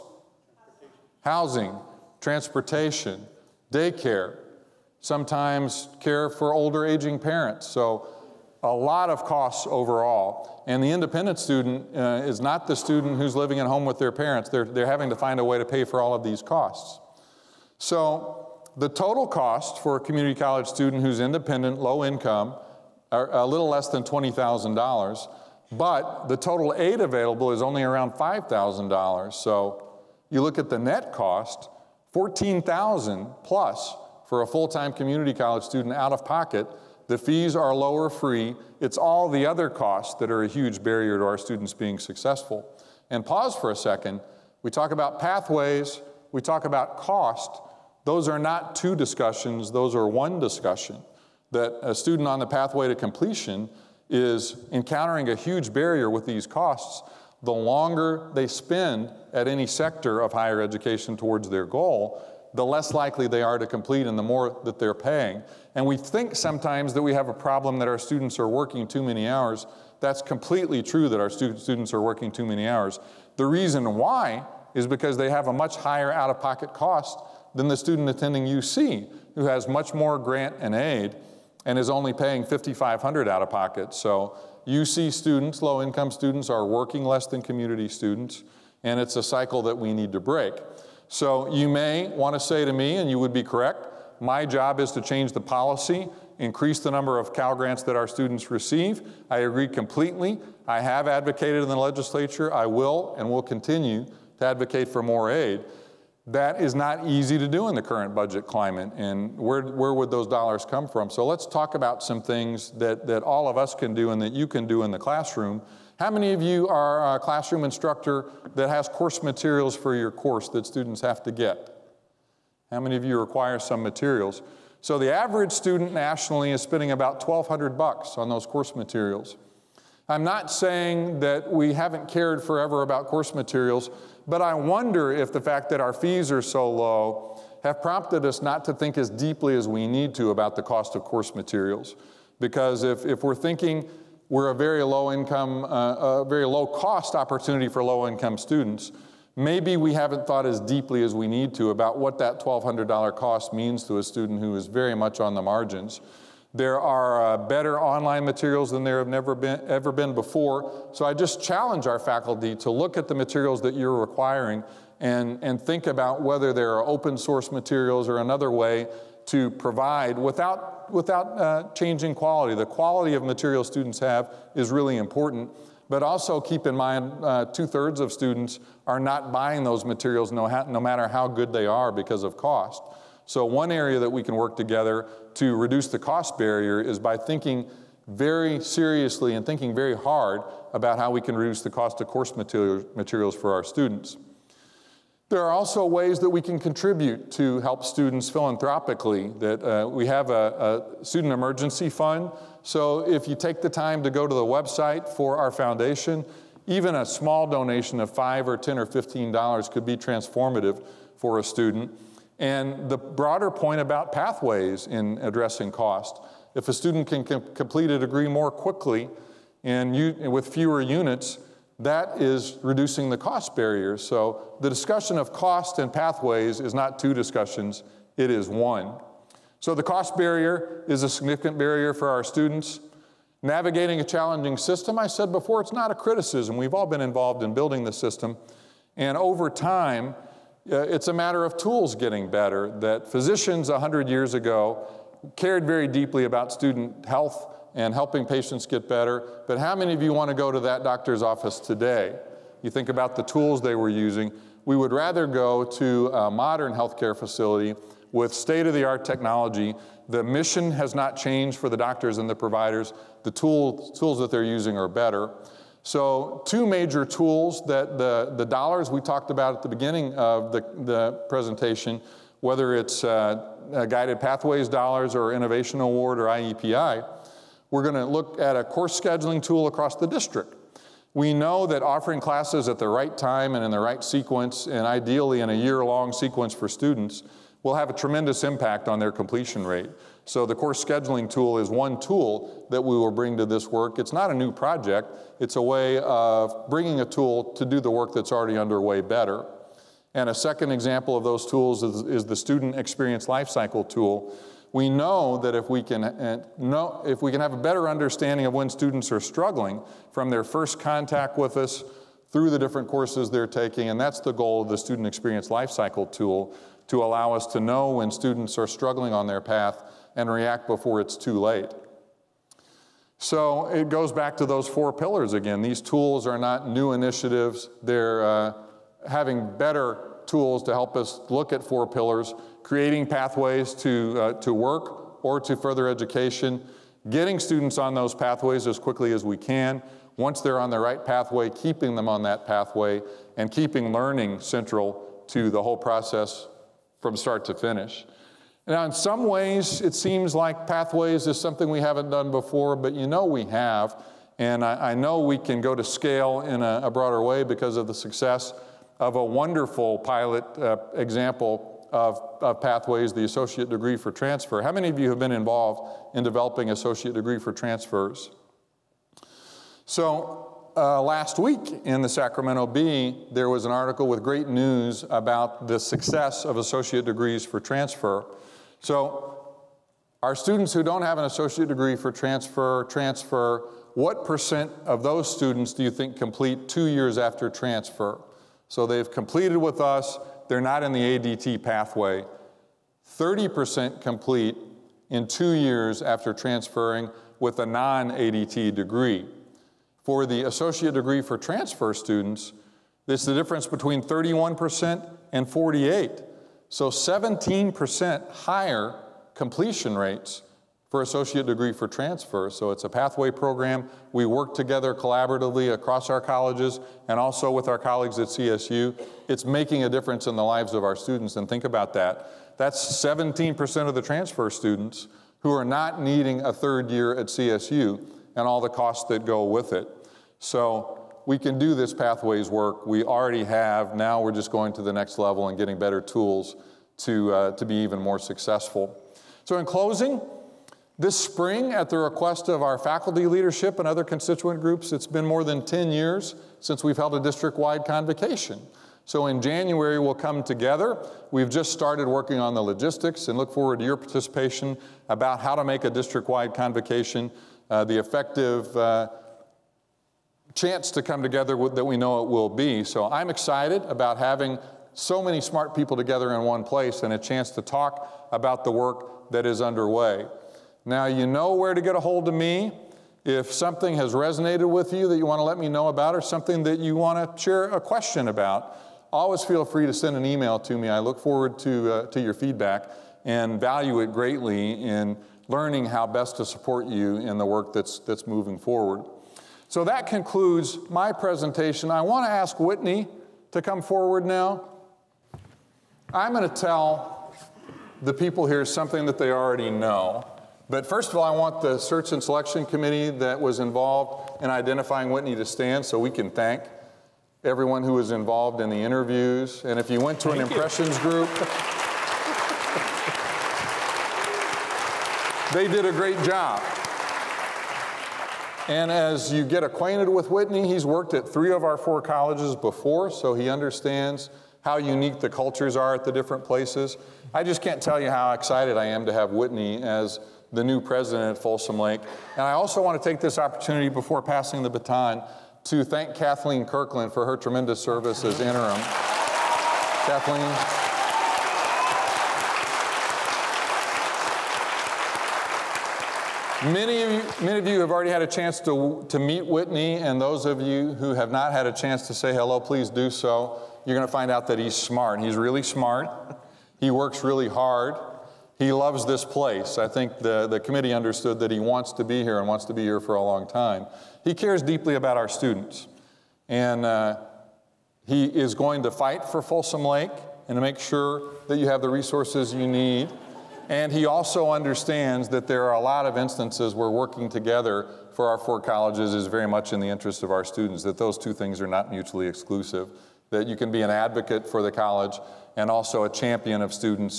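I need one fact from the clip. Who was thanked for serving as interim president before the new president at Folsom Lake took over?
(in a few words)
Kathleen Kirkland.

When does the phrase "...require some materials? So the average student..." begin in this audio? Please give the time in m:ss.
2:03.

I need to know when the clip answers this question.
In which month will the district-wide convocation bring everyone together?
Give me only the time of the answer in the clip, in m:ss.
7:29.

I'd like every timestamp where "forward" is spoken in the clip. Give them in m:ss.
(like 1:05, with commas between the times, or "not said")
7:33, 8:01, 8:08, 8:13.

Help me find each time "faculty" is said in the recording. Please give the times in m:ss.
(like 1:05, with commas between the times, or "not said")
2:41, 7:22.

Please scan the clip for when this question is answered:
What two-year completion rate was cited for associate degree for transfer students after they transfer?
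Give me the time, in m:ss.
6:45.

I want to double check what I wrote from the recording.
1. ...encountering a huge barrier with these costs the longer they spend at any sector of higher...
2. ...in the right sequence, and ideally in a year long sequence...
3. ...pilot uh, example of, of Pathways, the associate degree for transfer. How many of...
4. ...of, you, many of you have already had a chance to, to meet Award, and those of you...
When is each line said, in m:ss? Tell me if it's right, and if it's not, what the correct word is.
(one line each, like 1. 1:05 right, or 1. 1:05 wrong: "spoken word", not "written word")
1. 0:54 right
2. 4:43 right
3. 5:59 right
4. 9:07 wrong: "Whitney", not "Award".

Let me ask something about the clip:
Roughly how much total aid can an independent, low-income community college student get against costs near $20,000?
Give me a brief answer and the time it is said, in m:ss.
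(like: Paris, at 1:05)
$5,000, at 0:28.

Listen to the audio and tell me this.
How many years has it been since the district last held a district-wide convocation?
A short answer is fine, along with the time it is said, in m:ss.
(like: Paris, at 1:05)
more than 10, at 7:25.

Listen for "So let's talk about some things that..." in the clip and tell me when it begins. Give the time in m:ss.
1:51.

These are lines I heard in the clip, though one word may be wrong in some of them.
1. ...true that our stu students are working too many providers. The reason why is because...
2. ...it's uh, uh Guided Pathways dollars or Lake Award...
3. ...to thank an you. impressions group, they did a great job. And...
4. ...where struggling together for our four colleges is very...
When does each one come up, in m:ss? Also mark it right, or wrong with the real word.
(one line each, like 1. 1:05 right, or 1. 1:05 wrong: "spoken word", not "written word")
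1. 1:10 wrong: "hours", not "providers"
2. 4:32 wrong: "Innovation", not "Lake"
3. 8:30 right
4. 9:36 wrong: "working", not "struggling".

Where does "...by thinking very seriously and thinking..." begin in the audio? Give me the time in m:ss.
3:06.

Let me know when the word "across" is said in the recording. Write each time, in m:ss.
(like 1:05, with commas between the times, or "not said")
4:39, 6:55.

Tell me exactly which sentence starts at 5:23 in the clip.
So it goes back to those four pillars again.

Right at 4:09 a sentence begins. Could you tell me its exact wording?
But how many of you want to go to that doctor's office today?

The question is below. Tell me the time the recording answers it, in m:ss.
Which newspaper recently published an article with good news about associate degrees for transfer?
6:12.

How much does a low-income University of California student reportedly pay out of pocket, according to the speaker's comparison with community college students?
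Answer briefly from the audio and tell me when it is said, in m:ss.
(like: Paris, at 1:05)
5500, at 1:22.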